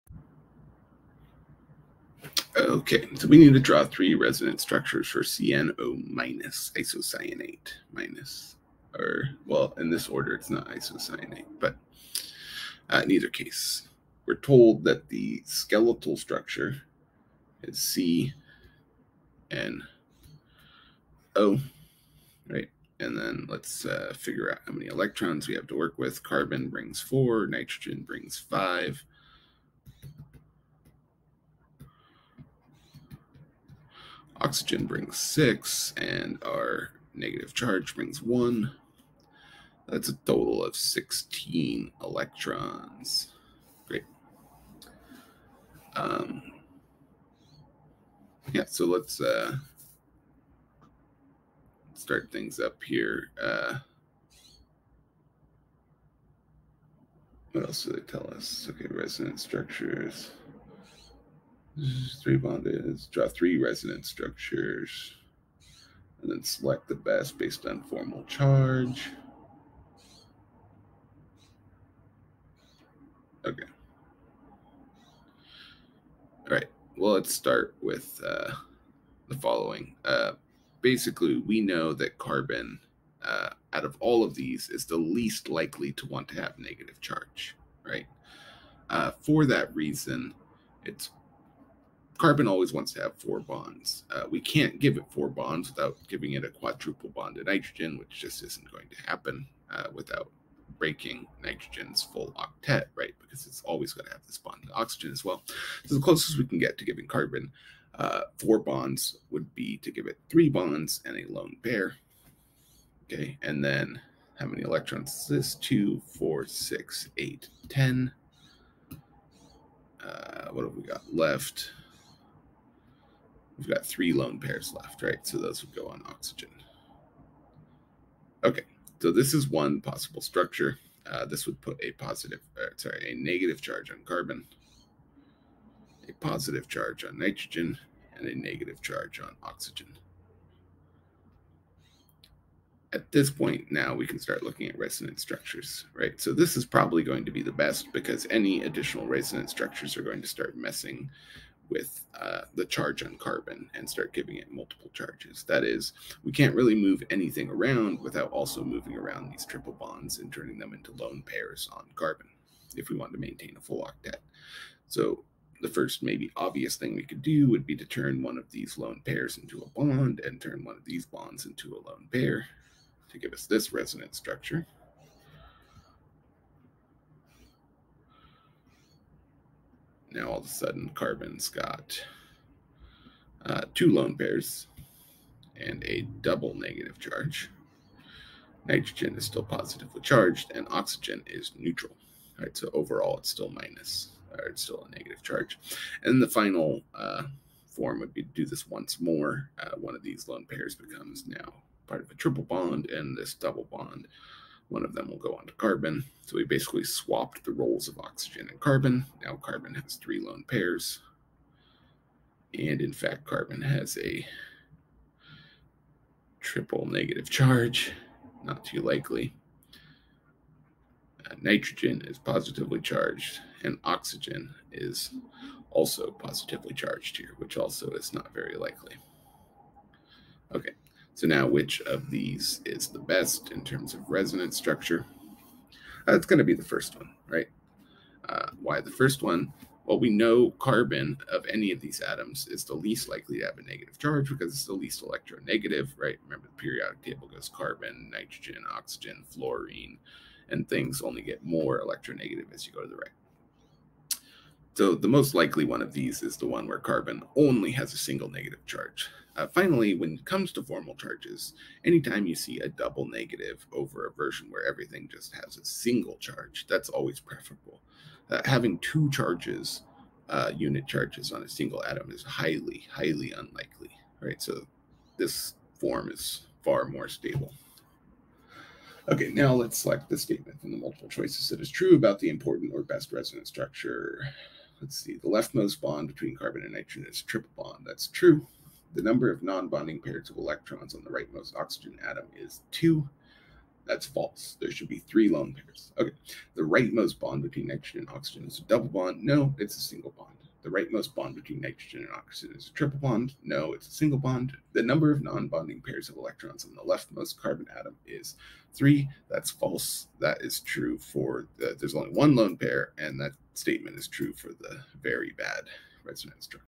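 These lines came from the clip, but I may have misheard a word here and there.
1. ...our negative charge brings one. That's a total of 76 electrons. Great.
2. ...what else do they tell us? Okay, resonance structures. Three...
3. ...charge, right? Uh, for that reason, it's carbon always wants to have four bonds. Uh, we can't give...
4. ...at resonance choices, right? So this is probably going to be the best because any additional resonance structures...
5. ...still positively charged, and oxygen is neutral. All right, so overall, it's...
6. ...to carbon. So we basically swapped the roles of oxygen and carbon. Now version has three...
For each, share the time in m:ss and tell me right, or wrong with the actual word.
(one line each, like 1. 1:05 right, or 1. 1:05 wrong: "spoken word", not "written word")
1. 0:36 wrong: "16", not "76"
2. 0:57 right
3. 1:26 right
4. 2:24 wrong: "structures", not "choices"
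5. 3:09 right
6. 3:25 wrong: "carbon", not "version".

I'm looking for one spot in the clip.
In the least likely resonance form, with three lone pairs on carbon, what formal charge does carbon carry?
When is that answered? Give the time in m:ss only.
3:36.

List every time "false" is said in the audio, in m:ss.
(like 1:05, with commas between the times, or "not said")
4:54, 5:09.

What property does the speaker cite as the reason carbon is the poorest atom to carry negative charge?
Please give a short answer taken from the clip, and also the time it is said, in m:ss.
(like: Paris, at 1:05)
least electronegative, at 4:04.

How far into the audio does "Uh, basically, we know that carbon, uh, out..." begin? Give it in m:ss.
1:20.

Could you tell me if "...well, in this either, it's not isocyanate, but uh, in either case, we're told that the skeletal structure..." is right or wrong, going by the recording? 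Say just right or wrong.
wrong.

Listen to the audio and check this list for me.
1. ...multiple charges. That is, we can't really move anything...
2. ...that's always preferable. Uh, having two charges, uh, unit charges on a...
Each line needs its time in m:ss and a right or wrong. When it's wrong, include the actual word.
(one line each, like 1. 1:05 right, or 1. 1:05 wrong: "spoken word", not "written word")
1. 2:34 right
2. 4:26 right.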